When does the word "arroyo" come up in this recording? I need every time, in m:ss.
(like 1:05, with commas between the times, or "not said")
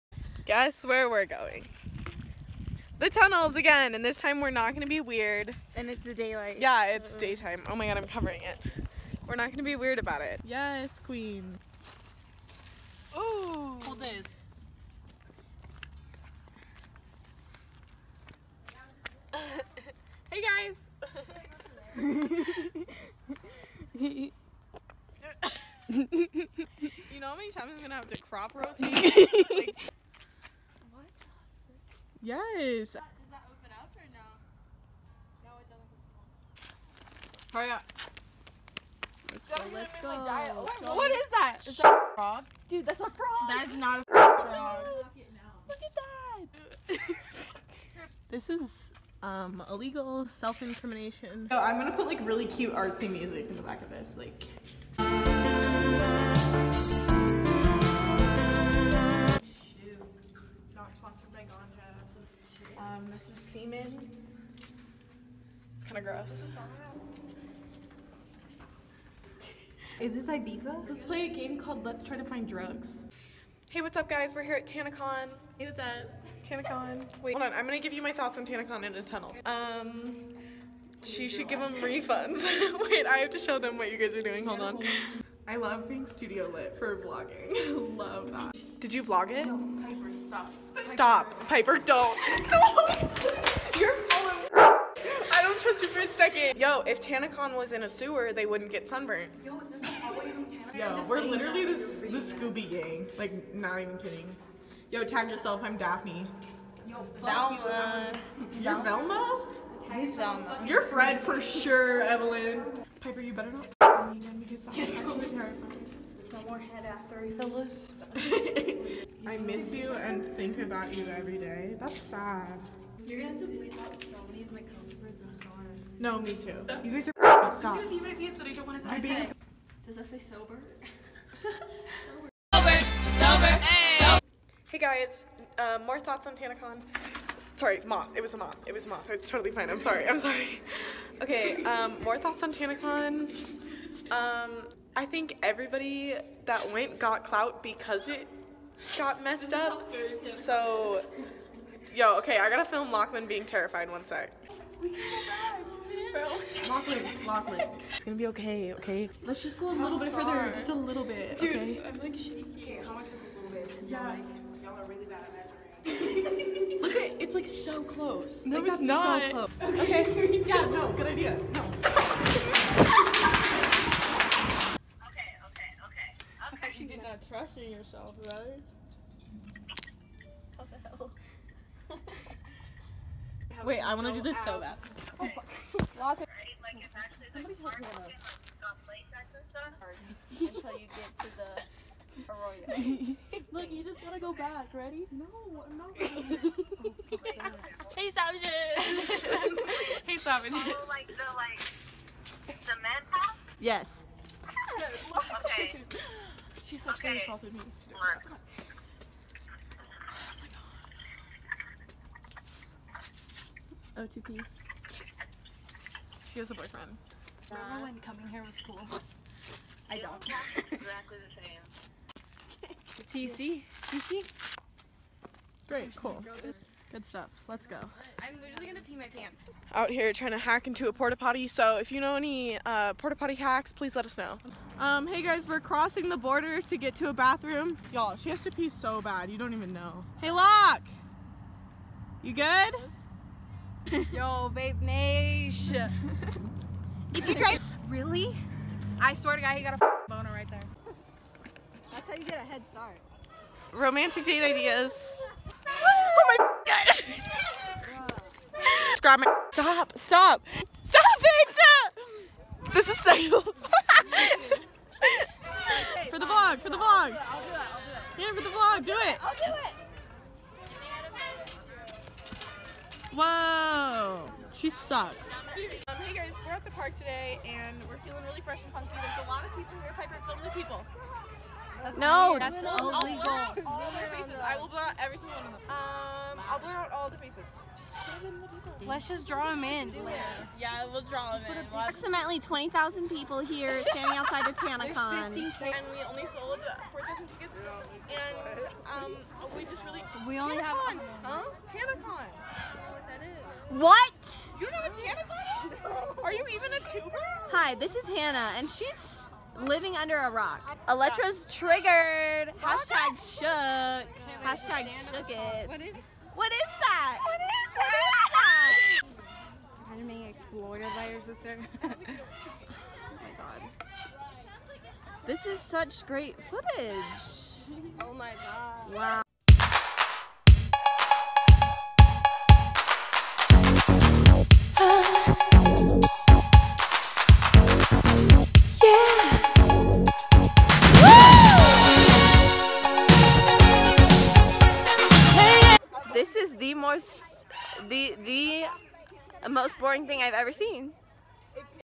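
3:12.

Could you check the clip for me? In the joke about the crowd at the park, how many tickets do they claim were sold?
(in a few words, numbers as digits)
4,000.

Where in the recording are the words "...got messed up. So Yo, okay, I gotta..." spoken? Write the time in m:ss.
2:28.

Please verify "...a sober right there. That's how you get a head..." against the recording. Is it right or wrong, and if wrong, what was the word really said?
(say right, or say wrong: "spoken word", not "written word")
wrong: "boner", not "sober".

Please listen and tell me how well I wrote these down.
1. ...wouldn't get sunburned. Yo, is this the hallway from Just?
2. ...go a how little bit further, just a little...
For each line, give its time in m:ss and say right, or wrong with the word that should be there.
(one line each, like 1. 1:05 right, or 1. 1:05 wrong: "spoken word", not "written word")
1. 1:38 wrong: "TanaCon", not "Just"
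2. 2:39 right.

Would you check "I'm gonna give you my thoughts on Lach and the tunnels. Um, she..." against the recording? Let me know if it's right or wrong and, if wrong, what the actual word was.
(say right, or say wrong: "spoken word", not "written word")
wrong: "TanaCon", not "Lach".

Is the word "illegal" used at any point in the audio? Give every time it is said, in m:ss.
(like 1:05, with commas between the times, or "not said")
0:49, 4:42.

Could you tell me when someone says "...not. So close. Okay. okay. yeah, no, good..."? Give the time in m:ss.
2:48.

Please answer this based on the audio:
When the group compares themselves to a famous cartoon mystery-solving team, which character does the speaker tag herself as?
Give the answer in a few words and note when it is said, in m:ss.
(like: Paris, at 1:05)
Daphne, at 1:45.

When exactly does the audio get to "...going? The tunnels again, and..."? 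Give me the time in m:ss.
0:01.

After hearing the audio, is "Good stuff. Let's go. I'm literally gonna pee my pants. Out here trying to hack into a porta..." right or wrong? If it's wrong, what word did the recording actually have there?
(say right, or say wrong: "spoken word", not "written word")
right.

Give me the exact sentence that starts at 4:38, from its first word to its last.
There's a lot of people here.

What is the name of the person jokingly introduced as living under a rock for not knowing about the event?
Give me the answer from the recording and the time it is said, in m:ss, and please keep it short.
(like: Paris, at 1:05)
Hannah, at 5:08.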